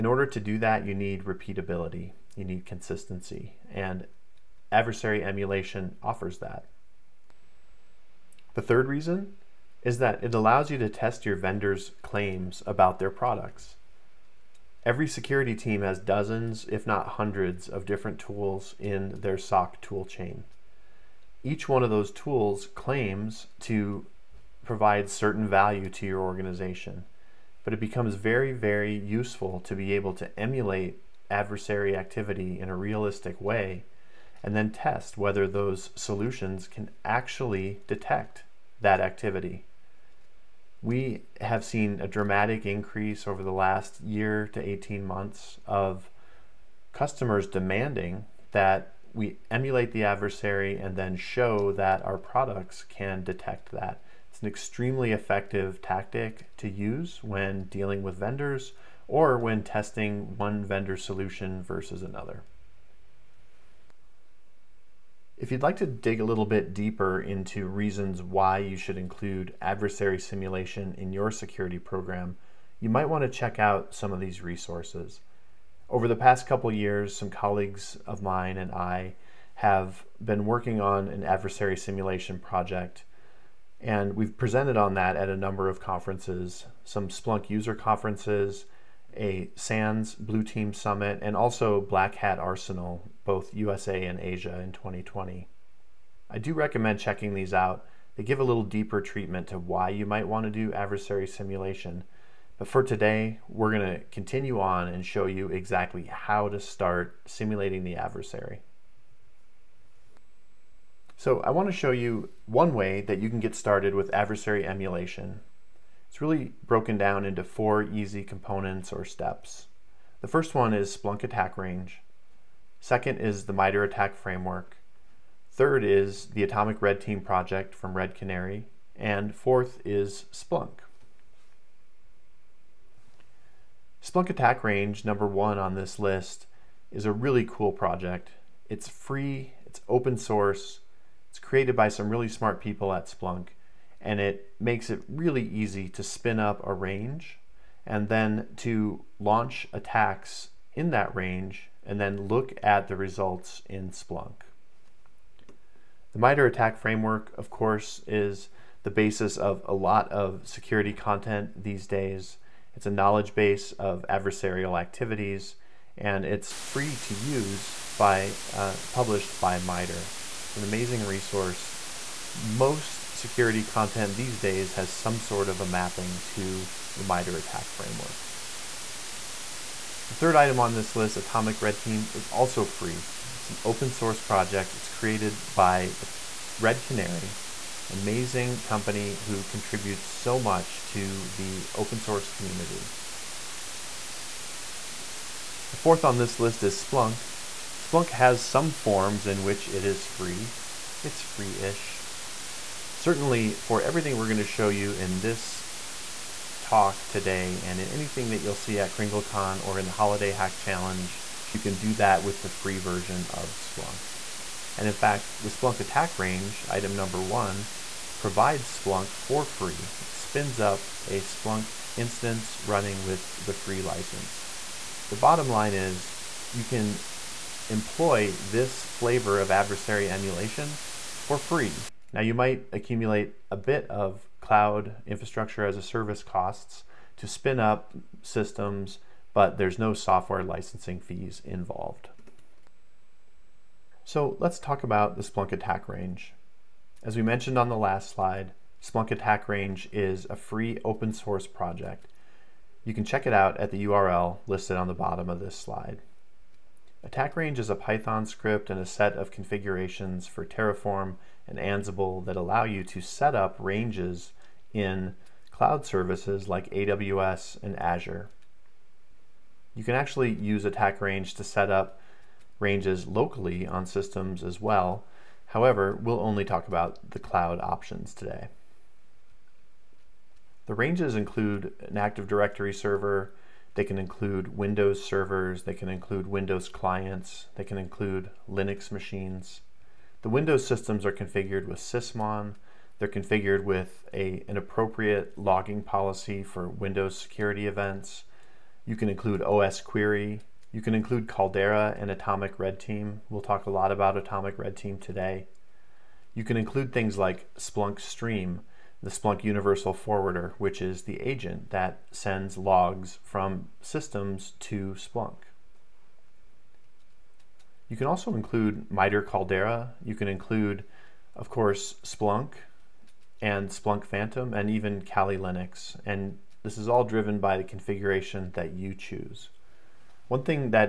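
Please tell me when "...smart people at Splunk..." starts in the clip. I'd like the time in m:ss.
2:22.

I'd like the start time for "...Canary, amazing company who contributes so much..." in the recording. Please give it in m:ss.
3:06.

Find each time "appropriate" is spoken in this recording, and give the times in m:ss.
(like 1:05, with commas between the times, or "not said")
4:54.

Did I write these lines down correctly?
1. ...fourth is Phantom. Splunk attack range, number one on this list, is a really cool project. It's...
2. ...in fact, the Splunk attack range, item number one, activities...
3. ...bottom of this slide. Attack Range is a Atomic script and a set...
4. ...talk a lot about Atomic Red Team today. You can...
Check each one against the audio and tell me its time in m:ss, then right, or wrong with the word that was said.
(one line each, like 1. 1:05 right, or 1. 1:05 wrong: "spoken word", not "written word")
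1. 2:09 wrong: "Splunk", not "Phantom"
2. 3:34 wrong: "provides", not "activities"
3. 4:14 wrong: "Python", not "Atomic"
4. 5:03 right.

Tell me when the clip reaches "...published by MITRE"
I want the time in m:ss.
2:48.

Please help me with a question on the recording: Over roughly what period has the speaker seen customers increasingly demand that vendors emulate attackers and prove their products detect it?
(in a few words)
18 months.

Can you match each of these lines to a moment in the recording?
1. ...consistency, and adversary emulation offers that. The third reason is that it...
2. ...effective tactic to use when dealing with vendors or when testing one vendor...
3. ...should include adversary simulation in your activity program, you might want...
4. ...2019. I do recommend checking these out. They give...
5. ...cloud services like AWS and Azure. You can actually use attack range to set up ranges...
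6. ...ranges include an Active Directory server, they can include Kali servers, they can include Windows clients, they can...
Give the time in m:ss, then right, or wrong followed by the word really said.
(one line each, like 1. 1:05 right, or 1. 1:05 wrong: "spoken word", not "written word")
1. 0:02 right
2. 0:55 right
3. 1:08 wrong: "security", not "activity"
4. 1:34 wrong: "2020", not "2019"
5. 4:25 right
6. 4:40 wrong: "Windows", not "Kali".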